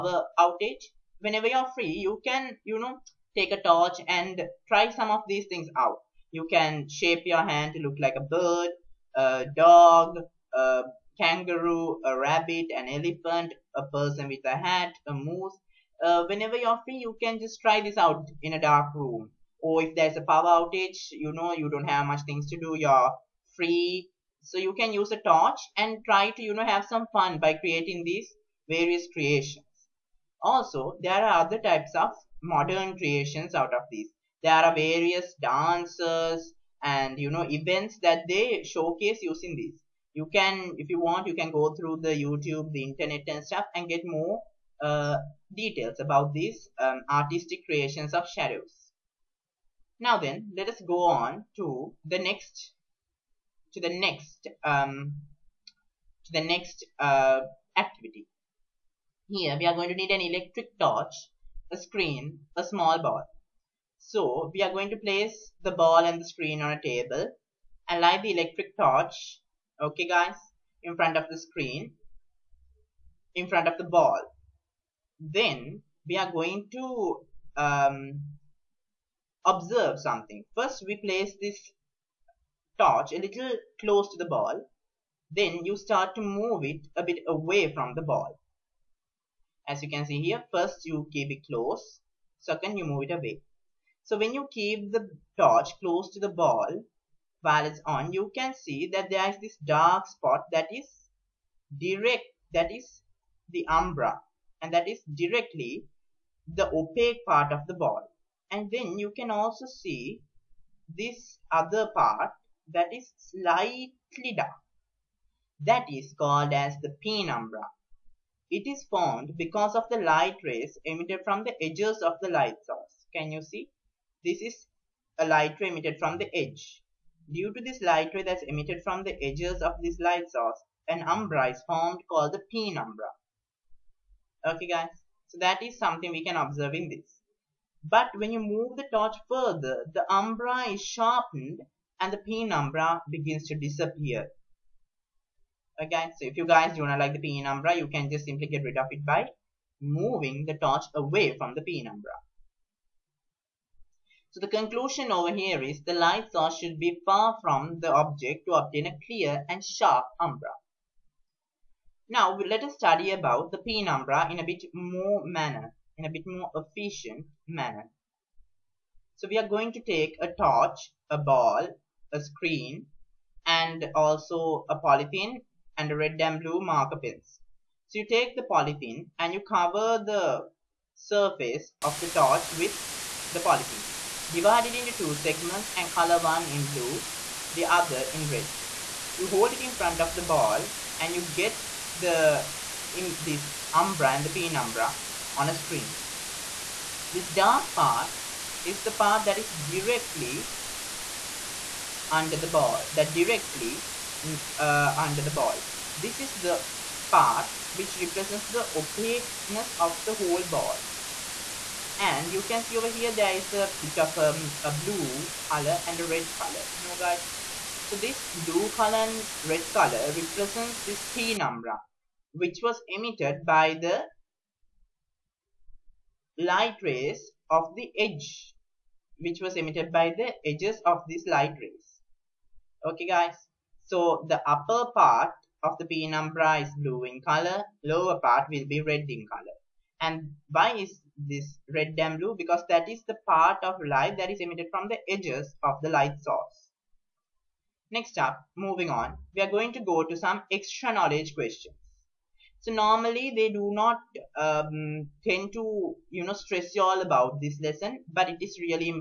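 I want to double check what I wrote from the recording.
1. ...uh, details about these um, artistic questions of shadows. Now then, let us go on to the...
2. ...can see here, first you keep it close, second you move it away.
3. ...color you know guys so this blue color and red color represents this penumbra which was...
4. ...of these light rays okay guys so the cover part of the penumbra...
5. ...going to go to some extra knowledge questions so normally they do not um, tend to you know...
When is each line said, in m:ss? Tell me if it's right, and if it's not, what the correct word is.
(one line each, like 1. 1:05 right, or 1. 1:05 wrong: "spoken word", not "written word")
1. 0:44 wrong: "creations", not "questions"
2. 1:29 right
3. 3:36 right
4. 3:50 wrong: "upper", not "cover"
5. 4:09 right.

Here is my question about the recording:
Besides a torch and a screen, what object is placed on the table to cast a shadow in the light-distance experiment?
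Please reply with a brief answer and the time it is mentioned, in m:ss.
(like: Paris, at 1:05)
A small ball, at 1:02.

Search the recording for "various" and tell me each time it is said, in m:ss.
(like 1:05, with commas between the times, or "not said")
0:28, 0:34.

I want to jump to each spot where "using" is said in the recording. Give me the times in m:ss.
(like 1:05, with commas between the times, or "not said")
0:39.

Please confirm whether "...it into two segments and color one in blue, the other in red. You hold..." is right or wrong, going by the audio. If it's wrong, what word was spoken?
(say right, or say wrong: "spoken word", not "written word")
right.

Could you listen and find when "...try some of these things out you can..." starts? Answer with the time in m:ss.
0:04.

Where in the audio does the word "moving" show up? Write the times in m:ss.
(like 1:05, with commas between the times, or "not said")
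2:29, 4:08.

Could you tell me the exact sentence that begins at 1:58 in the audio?
It is formed because of the light rays emitted from the edges of the light source.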